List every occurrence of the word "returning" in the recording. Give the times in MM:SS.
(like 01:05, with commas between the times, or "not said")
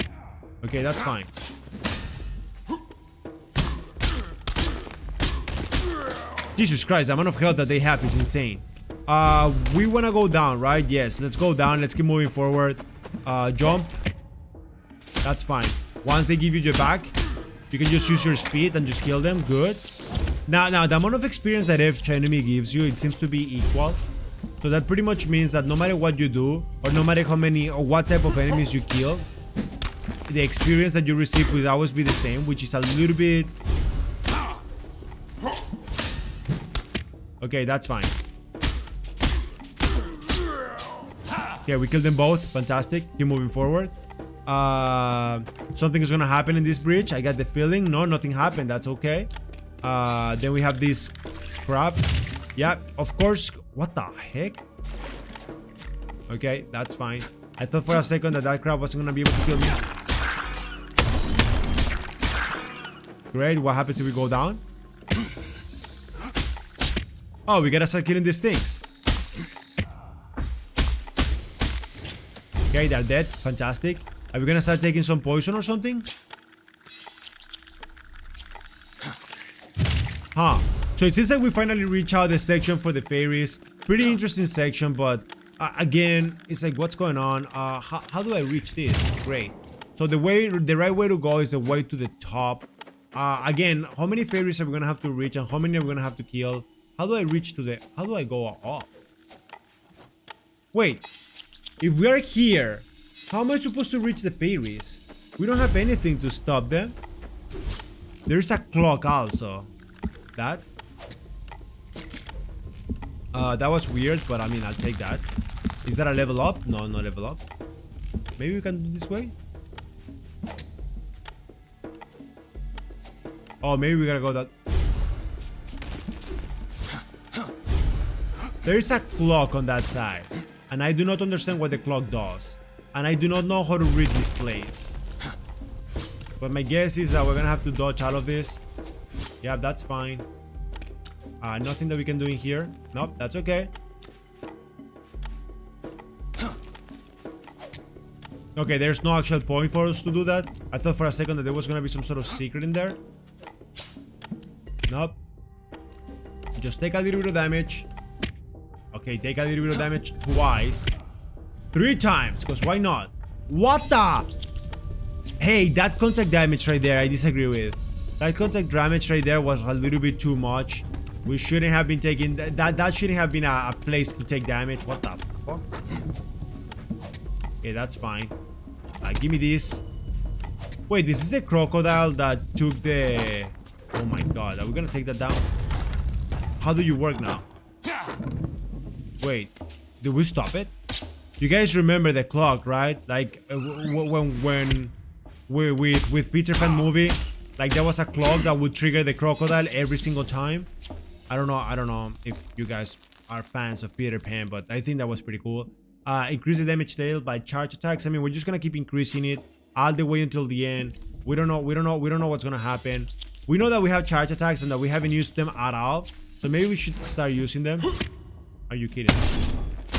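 not said.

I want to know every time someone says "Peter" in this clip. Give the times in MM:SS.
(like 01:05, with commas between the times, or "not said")
03:16, 03:23.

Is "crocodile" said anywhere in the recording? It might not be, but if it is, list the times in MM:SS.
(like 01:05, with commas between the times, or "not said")
03:01, 03:19.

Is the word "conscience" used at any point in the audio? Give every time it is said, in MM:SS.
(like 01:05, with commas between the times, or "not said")
not said.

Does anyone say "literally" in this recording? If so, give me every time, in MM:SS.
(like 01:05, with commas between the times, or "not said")
not said.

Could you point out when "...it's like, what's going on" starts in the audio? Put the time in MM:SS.
01:26.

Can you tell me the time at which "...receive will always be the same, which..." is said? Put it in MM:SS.
00:31.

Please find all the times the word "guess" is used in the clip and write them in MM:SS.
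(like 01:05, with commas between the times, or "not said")
02:16.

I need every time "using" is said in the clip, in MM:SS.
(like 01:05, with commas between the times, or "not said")
03:37.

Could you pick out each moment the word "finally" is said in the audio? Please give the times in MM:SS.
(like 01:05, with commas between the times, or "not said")
01:21.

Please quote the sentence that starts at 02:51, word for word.
We shouldn't have been taking that.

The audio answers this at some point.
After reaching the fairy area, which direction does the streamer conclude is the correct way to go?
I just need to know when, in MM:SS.
01:31.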